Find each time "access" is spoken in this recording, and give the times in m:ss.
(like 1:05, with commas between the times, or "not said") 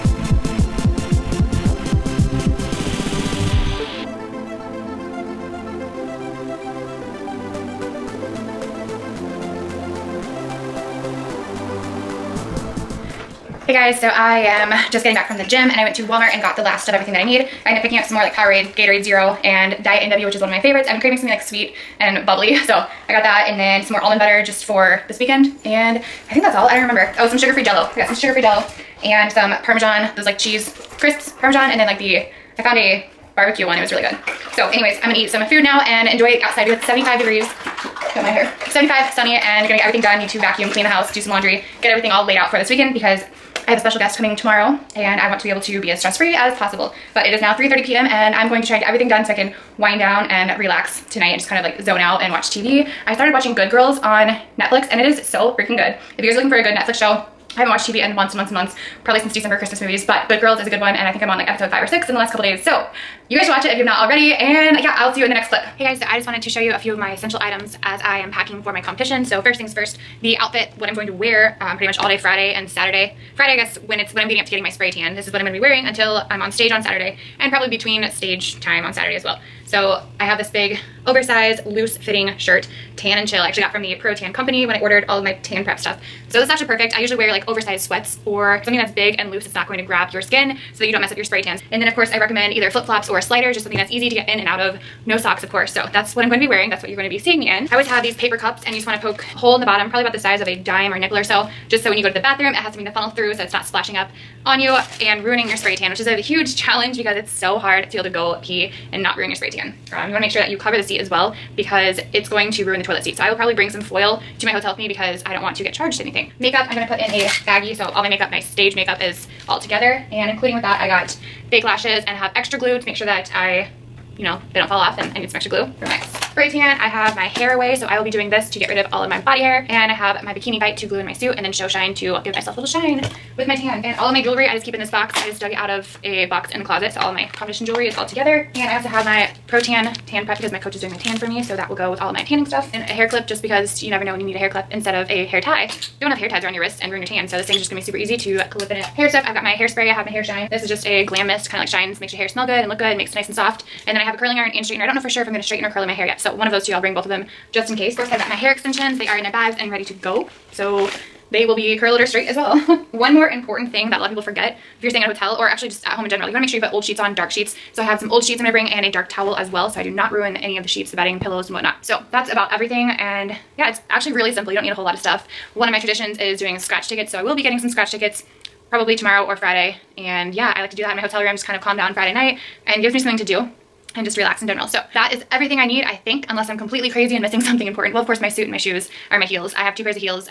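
not said.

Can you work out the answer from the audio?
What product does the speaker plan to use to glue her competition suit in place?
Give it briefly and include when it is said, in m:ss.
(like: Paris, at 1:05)
bikini bite, at 2:10.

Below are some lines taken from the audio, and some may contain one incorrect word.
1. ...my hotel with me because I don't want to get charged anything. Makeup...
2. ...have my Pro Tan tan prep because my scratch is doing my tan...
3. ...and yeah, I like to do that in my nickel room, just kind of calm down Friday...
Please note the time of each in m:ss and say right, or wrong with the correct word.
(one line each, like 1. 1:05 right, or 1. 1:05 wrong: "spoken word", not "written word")
1. 1:54 right
2. 2:18 wrong: "coach", not "scratch"
3. 2:59 wrong: "hotel", not "nickel".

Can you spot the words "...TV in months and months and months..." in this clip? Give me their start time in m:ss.
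0:57.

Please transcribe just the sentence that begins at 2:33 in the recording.
And then I have a curling iron and straightener.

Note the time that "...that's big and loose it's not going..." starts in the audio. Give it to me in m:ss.
1:28.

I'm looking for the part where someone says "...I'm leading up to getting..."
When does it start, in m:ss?
1:14.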